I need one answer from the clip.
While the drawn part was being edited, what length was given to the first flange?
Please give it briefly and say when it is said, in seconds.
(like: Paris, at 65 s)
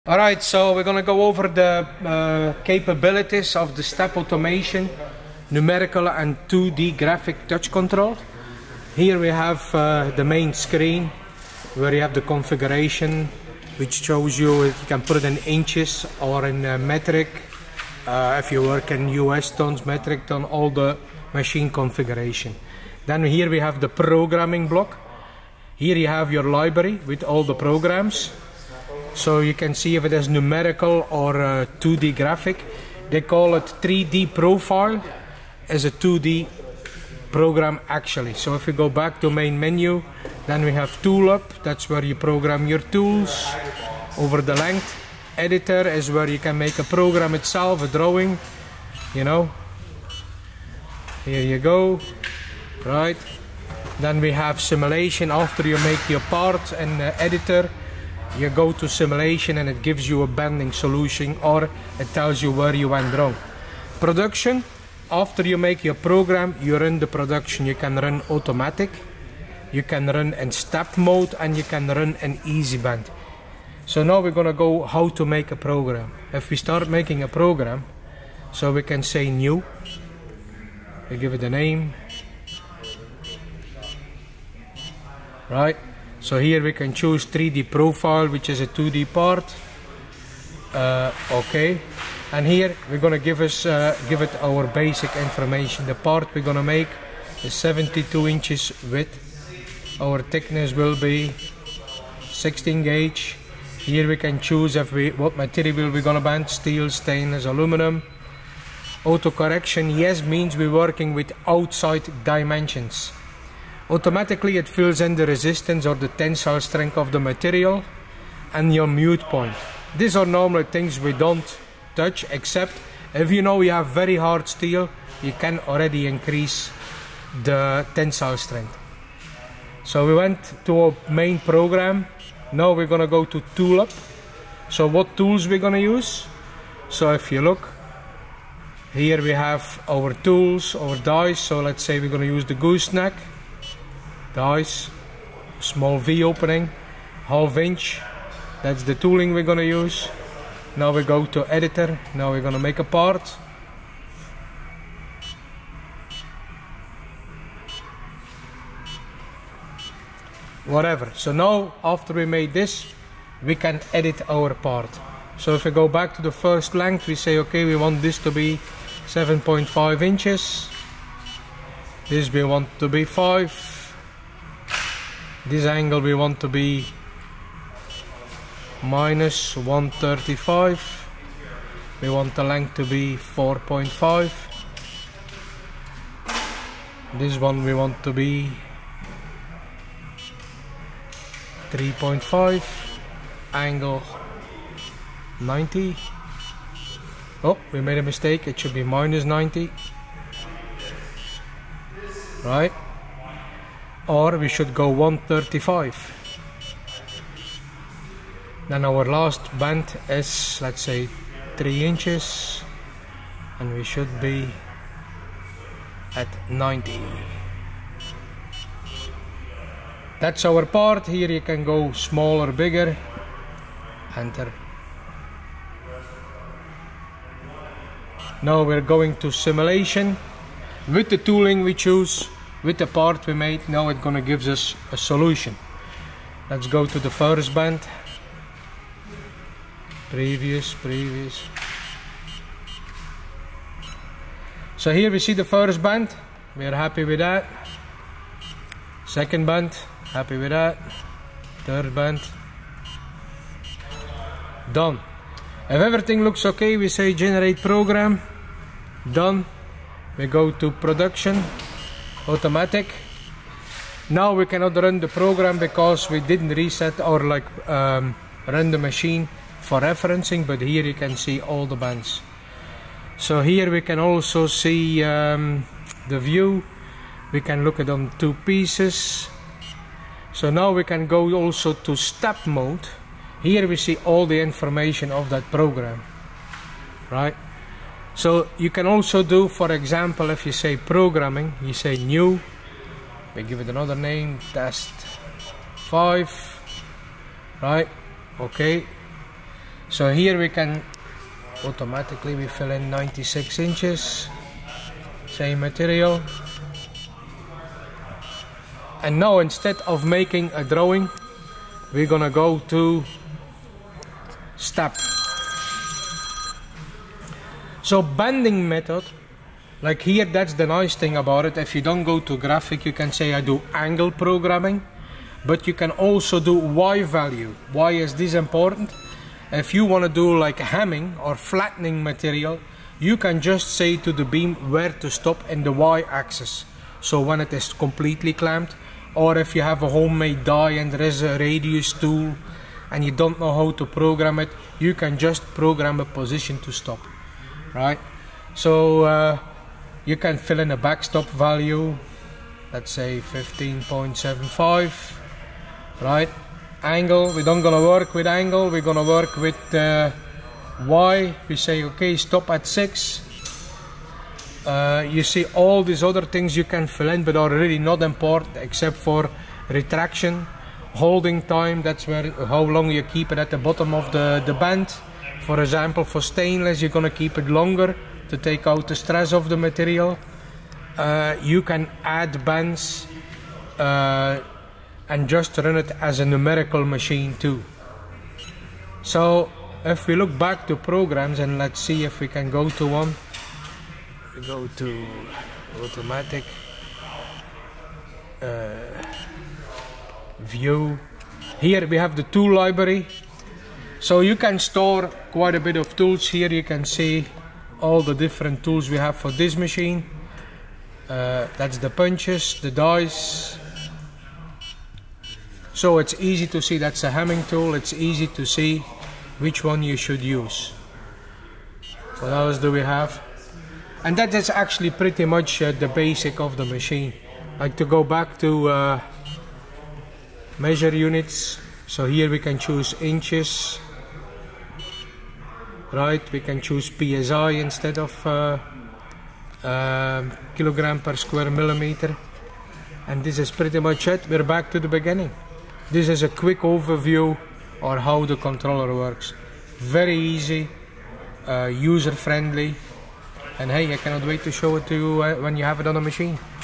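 7.5 inches, at 169 s.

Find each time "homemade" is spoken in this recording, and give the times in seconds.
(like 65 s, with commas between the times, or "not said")
339 s.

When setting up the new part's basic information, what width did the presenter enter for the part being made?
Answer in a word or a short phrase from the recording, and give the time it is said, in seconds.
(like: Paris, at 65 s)
72 inches, at 97 s.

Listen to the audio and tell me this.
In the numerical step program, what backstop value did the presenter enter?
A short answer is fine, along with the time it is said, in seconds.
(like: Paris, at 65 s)
15.75, at 353 s.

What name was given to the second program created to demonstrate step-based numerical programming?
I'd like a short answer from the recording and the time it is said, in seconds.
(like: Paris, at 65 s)
test 5, at 294 s.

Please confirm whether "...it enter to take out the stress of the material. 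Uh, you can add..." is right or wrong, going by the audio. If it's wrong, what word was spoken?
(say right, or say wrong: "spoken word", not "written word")
wrong: "longer", not "enter".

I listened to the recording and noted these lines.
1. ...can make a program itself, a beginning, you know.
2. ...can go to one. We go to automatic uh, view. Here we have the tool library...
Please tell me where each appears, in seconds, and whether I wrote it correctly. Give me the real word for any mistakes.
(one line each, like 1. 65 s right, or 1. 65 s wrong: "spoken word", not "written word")
1. 46 s wrong: "drawing", not "beginning"
2. 392 s right.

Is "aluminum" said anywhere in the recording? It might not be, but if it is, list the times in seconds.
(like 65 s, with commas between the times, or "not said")
107 s.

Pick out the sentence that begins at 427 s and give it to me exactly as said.
Like to go back to uh, measure units.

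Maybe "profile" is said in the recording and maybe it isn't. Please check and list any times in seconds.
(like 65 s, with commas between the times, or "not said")
34 s, 87 s.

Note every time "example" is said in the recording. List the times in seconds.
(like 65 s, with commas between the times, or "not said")
289 s, 375 s.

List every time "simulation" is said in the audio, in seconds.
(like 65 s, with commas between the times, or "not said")
54 s, 58 s, 229 s.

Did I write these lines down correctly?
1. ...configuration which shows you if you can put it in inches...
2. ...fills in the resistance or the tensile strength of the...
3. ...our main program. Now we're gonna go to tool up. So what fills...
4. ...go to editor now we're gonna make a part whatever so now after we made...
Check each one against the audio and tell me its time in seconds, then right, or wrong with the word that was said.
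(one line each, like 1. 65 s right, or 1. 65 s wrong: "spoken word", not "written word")
1. 12 s right
2. 114 s right
3. 130 s wrong: "tools", not "fills"
4. 151 s right.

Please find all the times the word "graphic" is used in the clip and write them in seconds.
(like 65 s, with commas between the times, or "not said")
6 s, 32 s, 322 s.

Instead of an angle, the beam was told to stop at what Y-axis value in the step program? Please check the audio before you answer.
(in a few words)
6.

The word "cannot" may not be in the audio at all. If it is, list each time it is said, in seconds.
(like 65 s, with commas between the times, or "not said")
264 s, 453 s.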